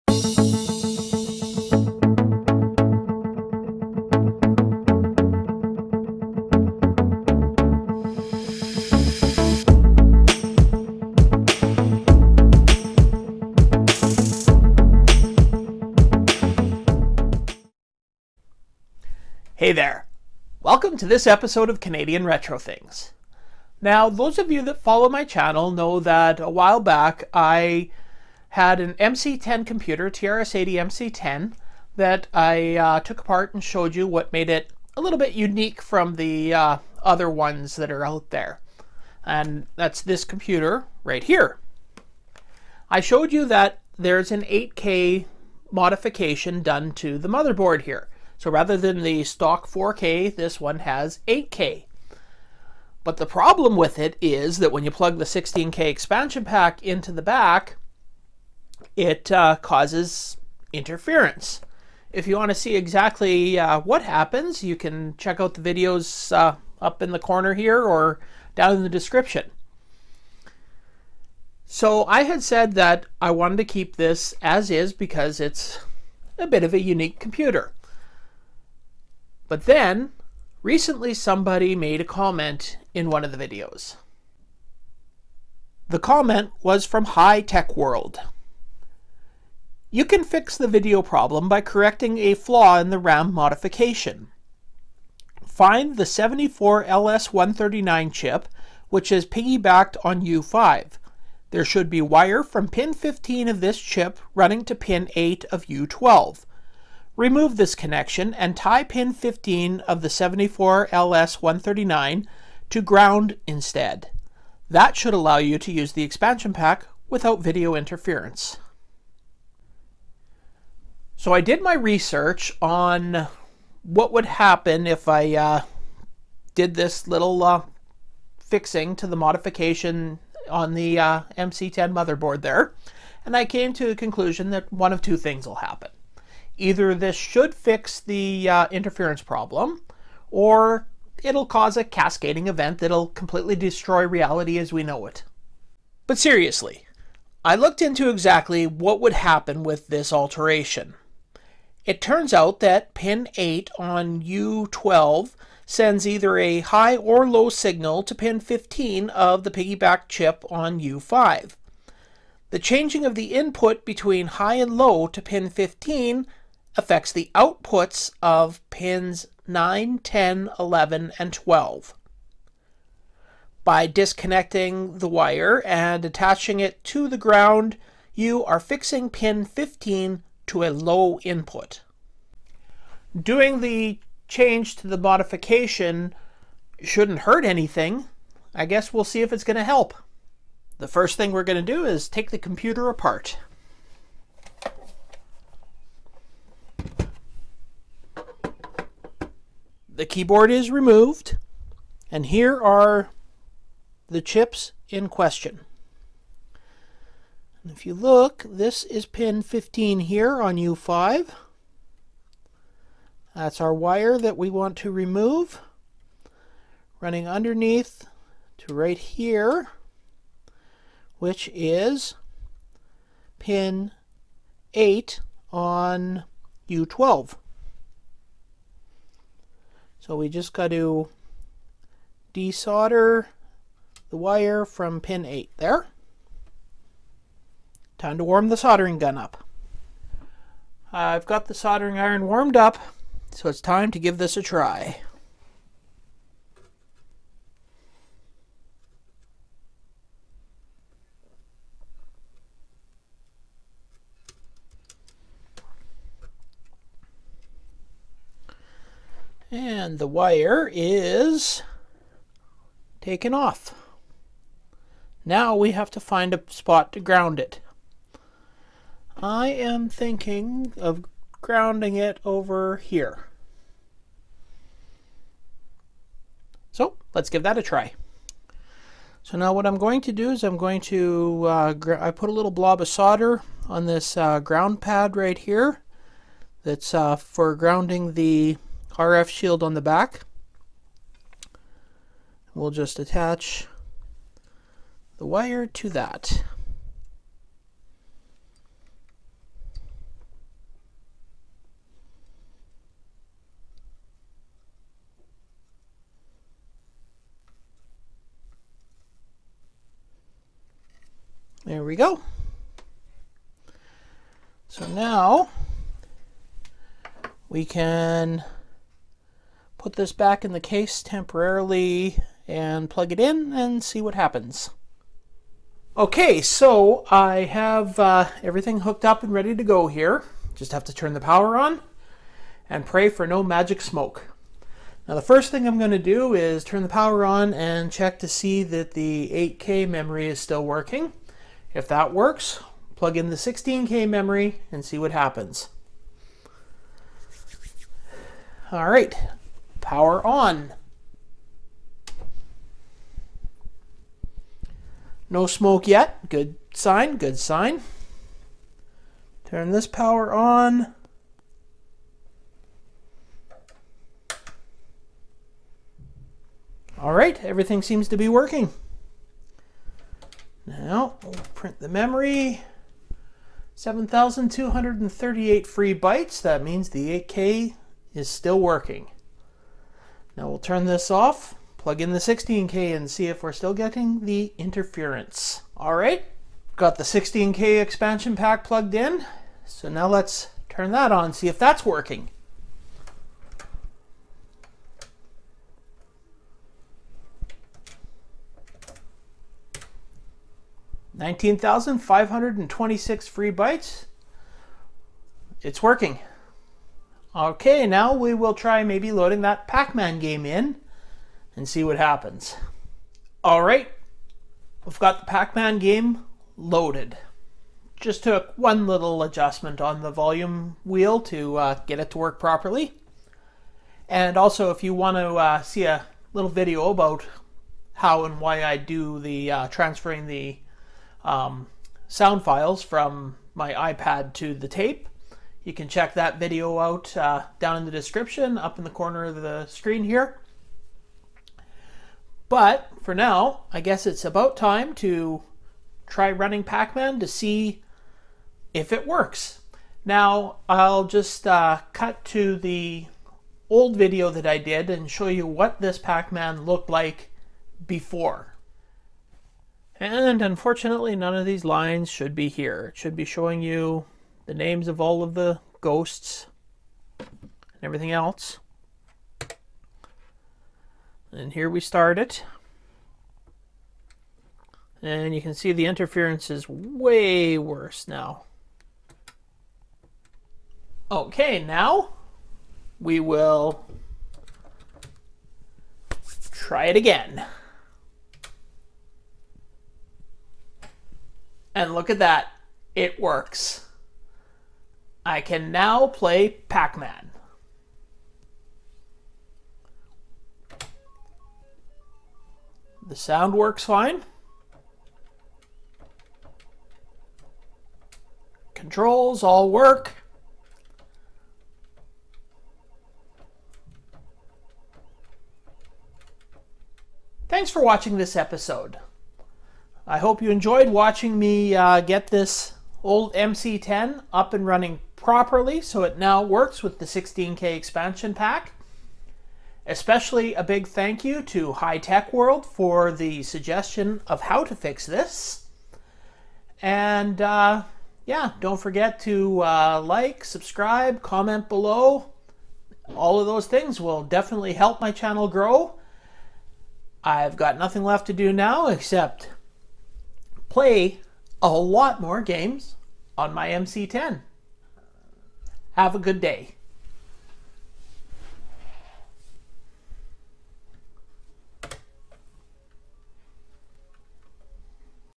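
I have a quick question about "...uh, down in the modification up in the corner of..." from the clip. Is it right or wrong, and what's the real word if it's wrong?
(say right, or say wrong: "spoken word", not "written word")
wrong: "description", not "modification".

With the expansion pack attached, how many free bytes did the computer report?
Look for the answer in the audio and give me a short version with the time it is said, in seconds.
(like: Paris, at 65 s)
19,526, at 401 s.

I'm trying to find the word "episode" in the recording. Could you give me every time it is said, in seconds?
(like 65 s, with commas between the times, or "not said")
21 s, 518 s.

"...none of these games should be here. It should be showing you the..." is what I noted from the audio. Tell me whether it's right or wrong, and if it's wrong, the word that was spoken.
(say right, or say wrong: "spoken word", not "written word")
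wrong: "lines", not "games".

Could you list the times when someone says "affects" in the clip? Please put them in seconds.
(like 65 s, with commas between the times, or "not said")
166 s.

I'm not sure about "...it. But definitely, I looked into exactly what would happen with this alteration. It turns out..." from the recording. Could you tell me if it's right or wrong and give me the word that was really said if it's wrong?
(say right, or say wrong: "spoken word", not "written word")
wrong: "seriously", not "definitely".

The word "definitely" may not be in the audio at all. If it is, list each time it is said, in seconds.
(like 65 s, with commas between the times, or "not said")
544 s.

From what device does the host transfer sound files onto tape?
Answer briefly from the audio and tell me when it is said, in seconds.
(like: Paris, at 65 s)
iPad, at 433 s.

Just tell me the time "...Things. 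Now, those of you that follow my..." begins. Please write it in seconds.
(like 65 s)
22 s.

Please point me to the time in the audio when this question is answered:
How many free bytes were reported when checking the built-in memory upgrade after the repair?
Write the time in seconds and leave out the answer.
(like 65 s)
373 s.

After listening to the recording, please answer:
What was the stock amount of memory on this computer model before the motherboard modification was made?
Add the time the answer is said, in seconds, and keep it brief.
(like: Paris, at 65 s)
4K, at 49 s.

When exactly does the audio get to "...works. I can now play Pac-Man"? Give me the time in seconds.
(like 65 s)
493 s.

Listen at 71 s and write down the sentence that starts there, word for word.
So I had said that I wanted to keep this as is because it's a bit of a unique computer.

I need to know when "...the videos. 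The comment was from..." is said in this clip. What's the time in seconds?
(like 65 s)
83 s.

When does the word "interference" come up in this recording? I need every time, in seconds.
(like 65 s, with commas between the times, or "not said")
60 s, 117 s, 138 s, 384 s, 475 s.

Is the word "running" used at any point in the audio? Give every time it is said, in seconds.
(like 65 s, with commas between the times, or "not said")
104 s, 216 s, 446 s, 524 s.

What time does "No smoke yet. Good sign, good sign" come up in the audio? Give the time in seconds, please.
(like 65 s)
355 s.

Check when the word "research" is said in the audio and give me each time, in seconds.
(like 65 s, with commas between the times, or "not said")
121 s.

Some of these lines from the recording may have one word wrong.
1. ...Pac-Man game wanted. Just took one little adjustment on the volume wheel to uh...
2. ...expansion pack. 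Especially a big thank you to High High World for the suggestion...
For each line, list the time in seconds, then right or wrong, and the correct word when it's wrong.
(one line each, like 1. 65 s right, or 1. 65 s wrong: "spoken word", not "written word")
1. 415 s wrong: "loaded", not "wanted"
2. 527 s wrong: "Tech", not "High".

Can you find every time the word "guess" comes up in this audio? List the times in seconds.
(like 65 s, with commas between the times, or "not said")
188 s, 443 s.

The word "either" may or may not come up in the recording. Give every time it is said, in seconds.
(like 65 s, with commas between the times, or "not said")
136 s, 156 s.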